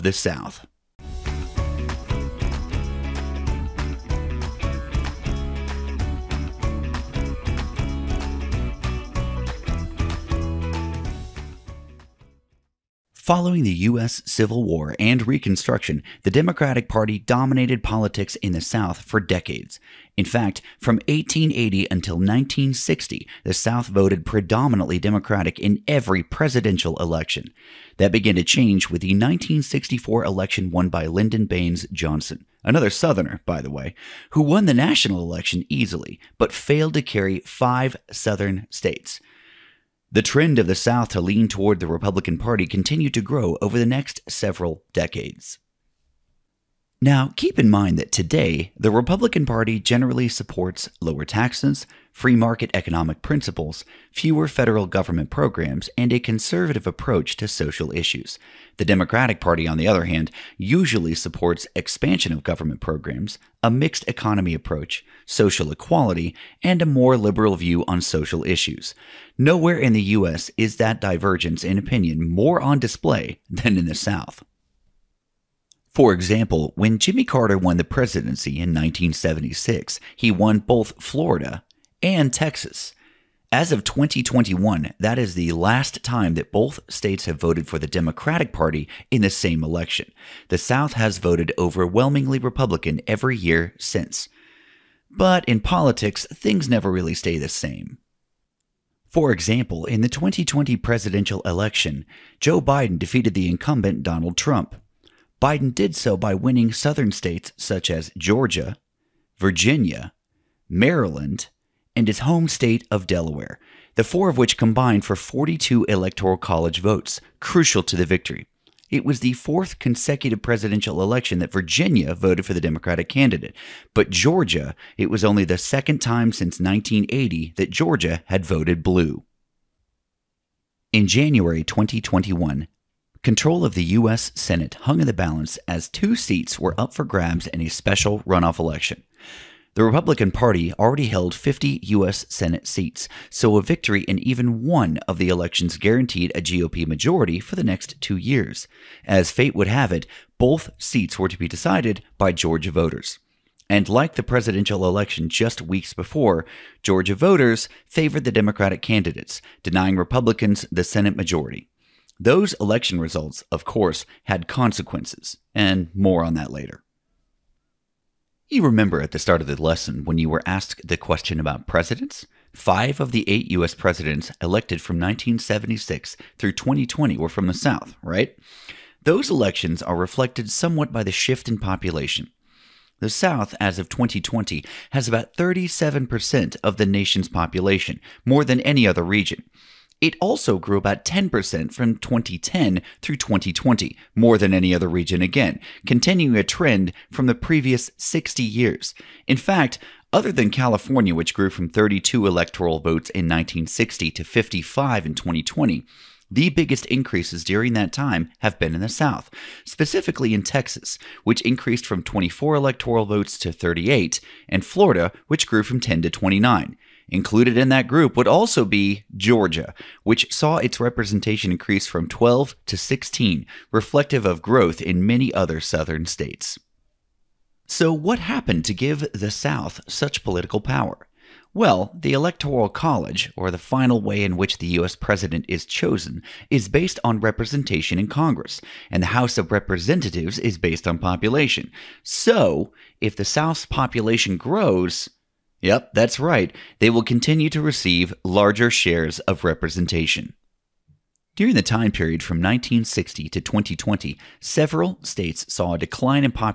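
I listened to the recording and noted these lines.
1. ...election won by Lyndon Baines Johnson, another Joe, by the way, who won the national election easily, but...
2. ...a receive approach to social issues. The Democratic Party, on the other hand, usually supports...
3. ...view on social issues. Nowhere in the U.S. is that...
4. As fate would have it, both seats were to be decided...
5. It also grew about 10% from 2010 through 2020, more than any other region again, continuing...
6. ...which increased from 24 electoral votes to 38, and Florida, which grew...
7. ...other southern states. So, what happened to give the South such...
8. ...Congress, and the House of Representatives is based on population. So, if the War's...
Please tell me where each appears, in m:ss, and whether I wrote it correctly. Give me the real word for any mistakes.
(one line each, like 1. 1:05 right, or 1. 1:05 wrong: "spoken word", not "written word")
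1. 0:30 wrong: "Southerner", not "Joe"
2. 0:56 wrong: "conservative", not "receive"
3. 1:07 right
4. 2:29 right
5. 3:09 right
6. 3:31 right
7. 3:45 right
8. 3:58 wrong: "South", not "War".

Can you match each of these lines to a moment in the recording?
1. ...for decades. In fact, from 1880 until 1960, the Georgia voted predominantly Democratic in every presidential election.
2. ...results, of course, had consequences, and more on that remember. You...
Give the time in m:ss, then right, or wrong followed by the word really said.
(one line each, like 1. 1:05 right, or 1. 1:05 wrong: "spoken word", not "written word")
1. 0:19 wrong: "South", not "Georgia"
2. 2:42 wrong: "later", not "remember".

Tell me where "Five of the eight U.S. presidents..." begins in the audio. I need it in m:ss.
2:52.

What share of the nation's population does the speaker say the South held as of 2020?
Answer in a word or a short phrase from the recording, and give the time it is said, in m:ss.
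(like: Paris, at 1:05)
37%, at 3:05.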